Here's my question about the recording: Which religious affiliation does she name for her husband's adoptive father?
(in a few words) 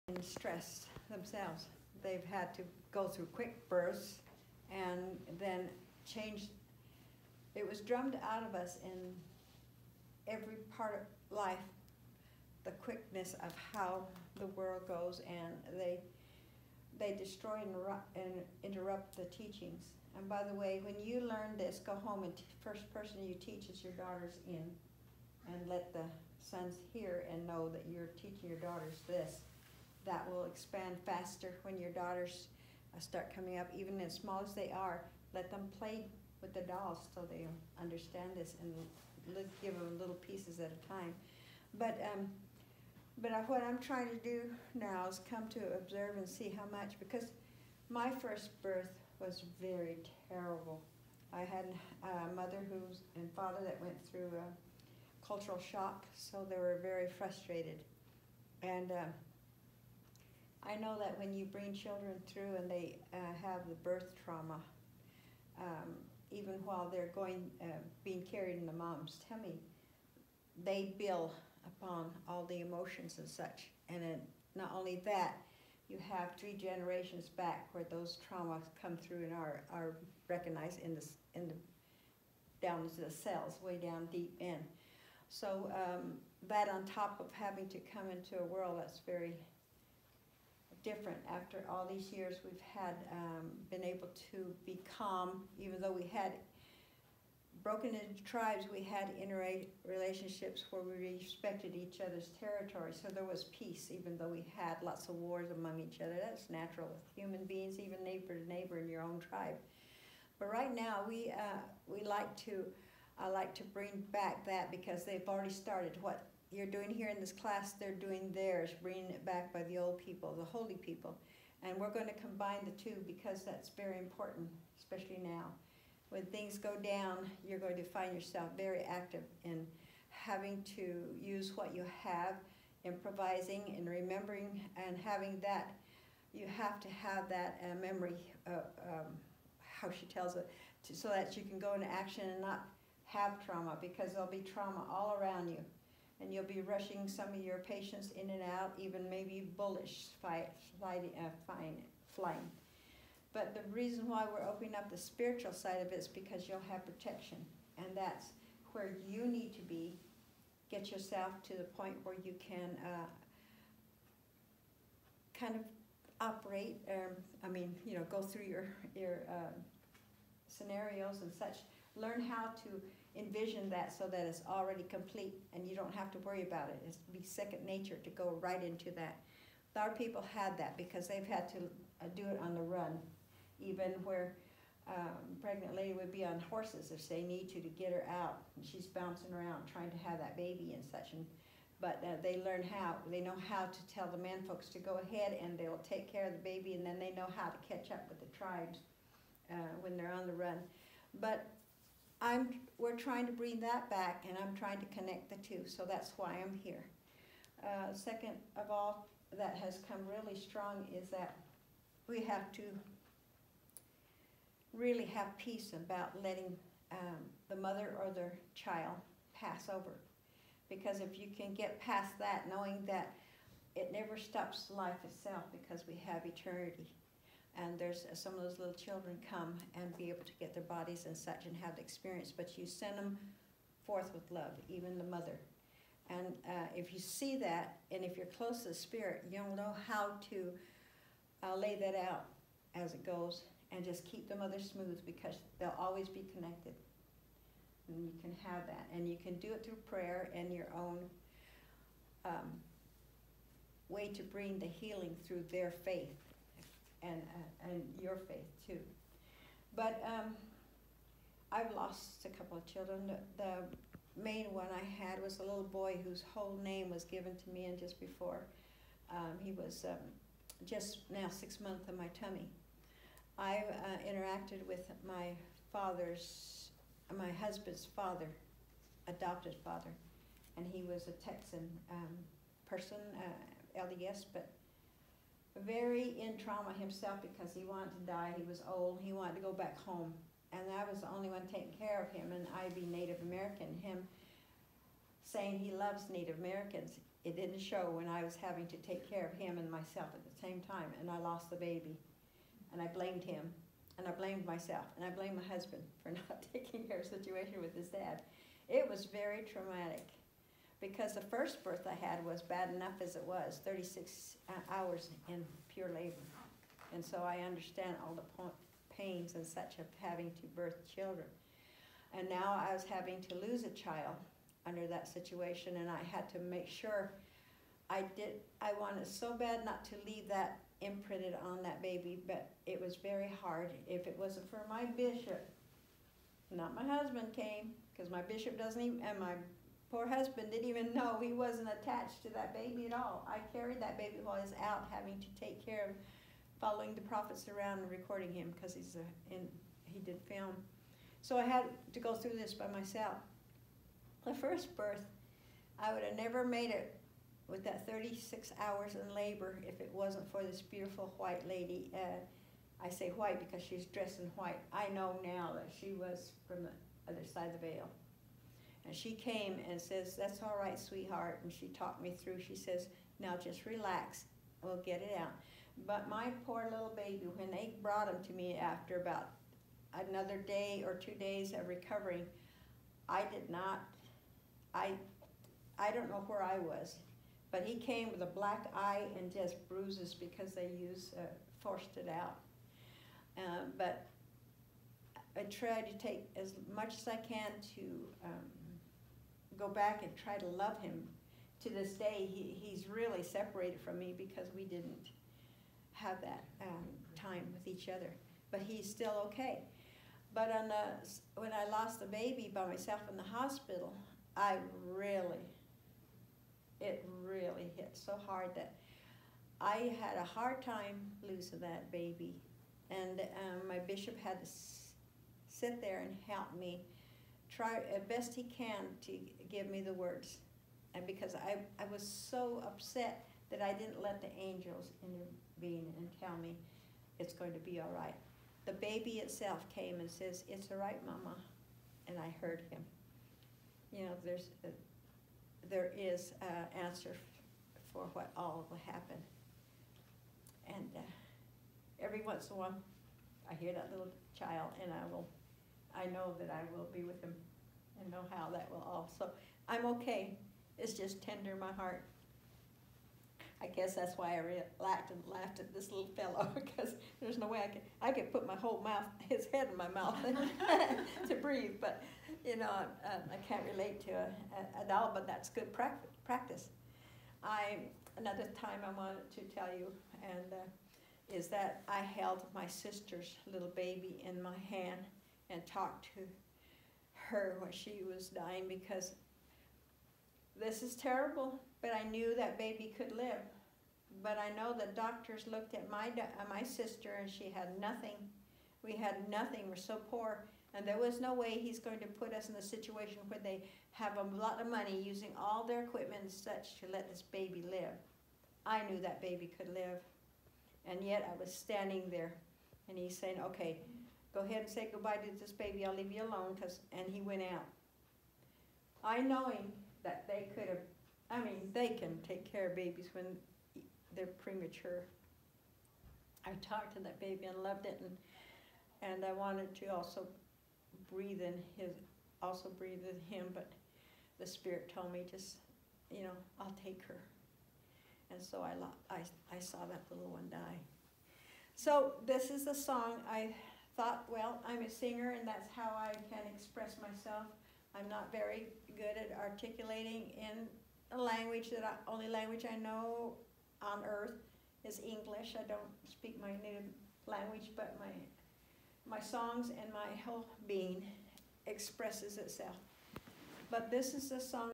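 LDS.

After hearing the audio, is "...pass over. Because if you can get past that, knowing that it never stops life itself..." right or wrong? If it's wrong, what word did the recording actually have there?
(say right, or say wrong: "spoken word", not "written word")
right.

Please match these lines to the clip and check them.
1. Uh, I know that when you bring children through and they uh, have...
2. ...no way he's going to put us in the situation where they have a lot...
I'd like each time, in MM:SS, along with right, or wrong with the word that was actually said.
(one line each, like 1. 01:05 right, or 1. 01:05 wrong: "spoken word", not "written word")
1. 00:58 right
2. 08:21 right.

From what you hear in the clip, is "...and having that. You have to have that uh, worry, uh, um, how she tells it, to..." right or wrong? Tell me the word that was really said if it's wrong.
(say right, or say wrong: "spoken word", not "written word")
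wrong: "memory", not "worry".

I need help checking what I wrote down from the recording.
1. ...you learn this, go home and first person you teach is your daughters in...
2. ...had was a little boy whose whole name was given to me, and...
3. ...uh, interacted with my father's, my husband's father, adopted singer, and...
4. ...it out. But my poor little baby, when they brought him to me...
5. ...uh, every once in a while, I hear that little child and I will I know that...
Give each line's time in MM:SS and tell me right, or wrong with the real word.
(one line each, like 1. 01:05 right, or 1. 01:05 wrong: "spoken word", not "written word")
1. 00:21 right
2. 04:25 right
3. 04:33 wrong: "father", not "singer"
4. 06:15 right
5. 07:30 right.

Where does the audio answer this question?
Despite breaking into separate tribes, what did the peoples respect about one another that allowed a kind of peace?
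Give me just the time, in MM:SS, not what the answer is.
01:42.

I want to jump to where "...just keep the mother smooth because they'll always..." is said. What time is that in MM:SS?
04:03.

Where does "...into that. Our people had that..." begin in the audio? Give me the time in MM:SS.
02:58.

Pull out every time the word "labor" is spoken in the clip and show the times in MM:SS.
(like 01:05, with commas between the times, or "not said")
05:15, 05:59.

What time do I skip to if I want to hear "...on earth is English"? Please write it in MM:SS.
09:13.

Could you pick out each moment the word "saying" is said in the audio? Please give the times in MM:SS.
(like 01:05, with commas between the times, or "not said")
04:55, 08:33.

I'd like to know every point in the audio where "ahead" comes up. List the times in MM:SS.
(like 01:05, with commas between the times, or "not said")
03:15, 08:34.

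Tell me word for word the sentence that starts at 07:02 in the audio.
And um, my bishop had to sit there and help me try as best he can to give me the words.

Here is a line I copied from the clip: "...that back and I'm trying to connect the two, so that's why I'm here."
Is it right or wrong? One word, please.
right.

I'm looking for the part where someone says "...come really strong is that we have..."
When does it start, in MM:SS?
03:29.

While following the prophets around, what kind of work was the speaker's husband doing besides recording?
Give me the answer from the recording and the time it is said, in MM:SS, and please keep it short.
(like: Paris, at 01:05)
film, at 05:50.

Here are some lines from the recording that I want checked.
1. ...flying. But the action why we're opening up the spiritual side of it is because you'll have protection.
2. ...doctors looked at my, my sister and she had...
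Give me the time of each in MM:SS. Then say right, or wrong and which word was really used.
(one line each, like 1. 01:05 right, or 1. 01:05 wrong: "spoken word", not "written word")
1. 02:32 wrong: "reason", not "action"
2. 08:14 right.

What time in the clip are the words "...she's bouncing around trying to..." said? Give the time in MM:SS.
03:08.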